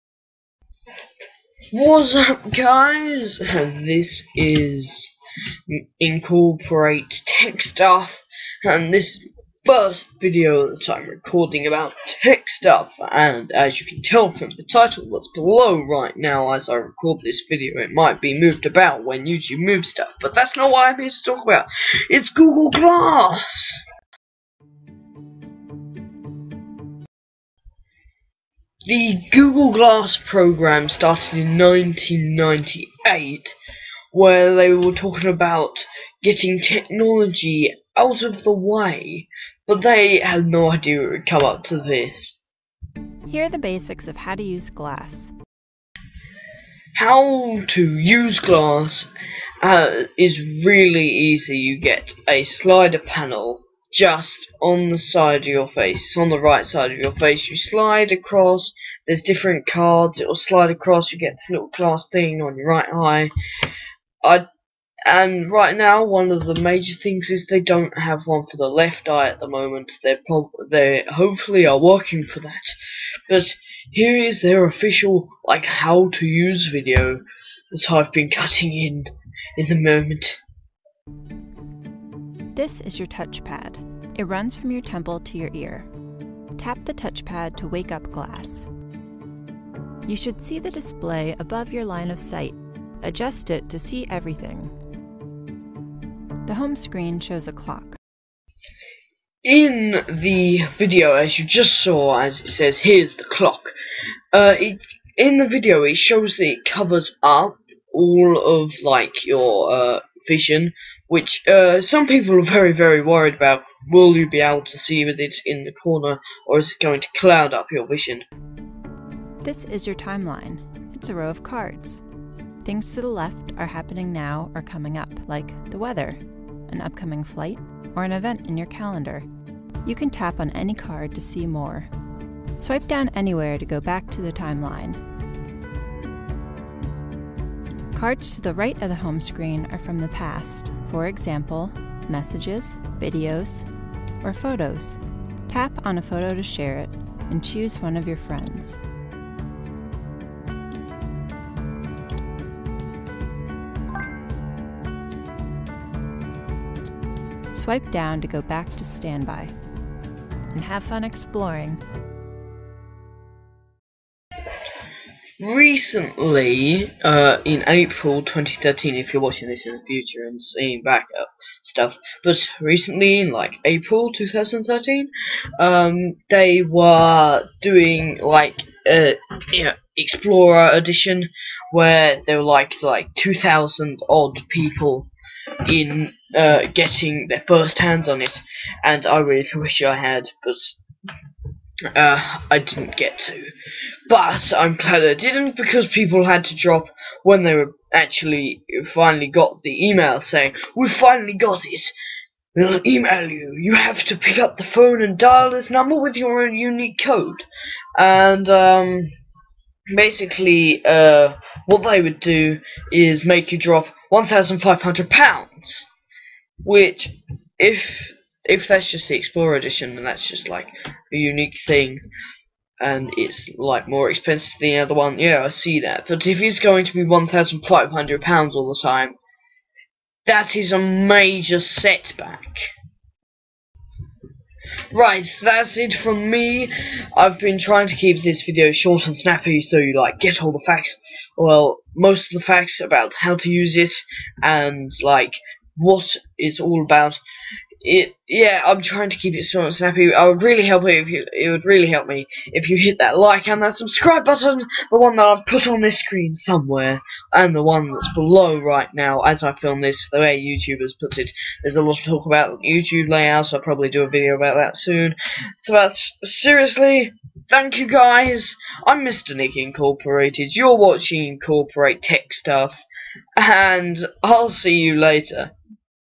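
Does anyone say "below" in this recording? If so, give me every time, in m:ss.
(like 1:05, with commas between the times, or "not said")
0:15, 4:18.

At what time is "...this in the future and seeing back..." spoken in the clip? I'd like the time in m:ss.
2:49.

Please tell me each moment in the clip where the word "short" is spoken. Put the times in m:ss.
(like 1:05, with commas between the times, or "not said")
3:58, 4:09.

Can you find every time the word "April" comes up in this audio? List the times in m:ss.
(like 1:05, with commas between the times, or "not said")
2:47, 2:53.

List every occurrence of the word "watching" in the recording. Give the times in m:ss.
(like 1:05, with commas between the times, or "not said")
2:49, 4:30.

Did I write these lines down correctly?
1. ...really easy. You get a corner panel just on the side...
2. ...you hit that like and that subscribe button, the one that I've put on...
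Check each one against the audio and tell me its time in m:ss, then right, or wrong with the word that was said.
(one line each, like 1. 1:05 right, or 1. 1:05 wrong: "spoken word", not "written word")
1. 0:50 wrong: "slider", not "corner"
2. 4:12 right.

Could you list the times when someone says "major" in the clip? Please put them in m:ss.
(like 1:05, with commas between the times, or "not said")
1:06, 3:50.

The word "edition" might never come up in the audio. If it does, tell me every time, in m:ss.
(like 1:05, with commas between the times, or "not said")
3:00, 3:39.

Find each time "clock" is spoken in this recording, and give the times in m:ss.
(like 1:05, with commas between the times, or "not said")
1:37, 1:43.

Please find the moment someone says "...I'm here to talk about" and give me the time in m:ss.
0:20.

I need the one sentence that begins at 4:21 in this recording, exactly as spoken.
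There's a lot of talk about YouTube layouts.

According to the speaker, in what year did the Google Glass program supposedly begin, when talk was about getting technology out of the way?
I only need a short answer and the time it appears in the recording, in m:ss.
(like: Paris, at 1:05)
1998, at 0:31.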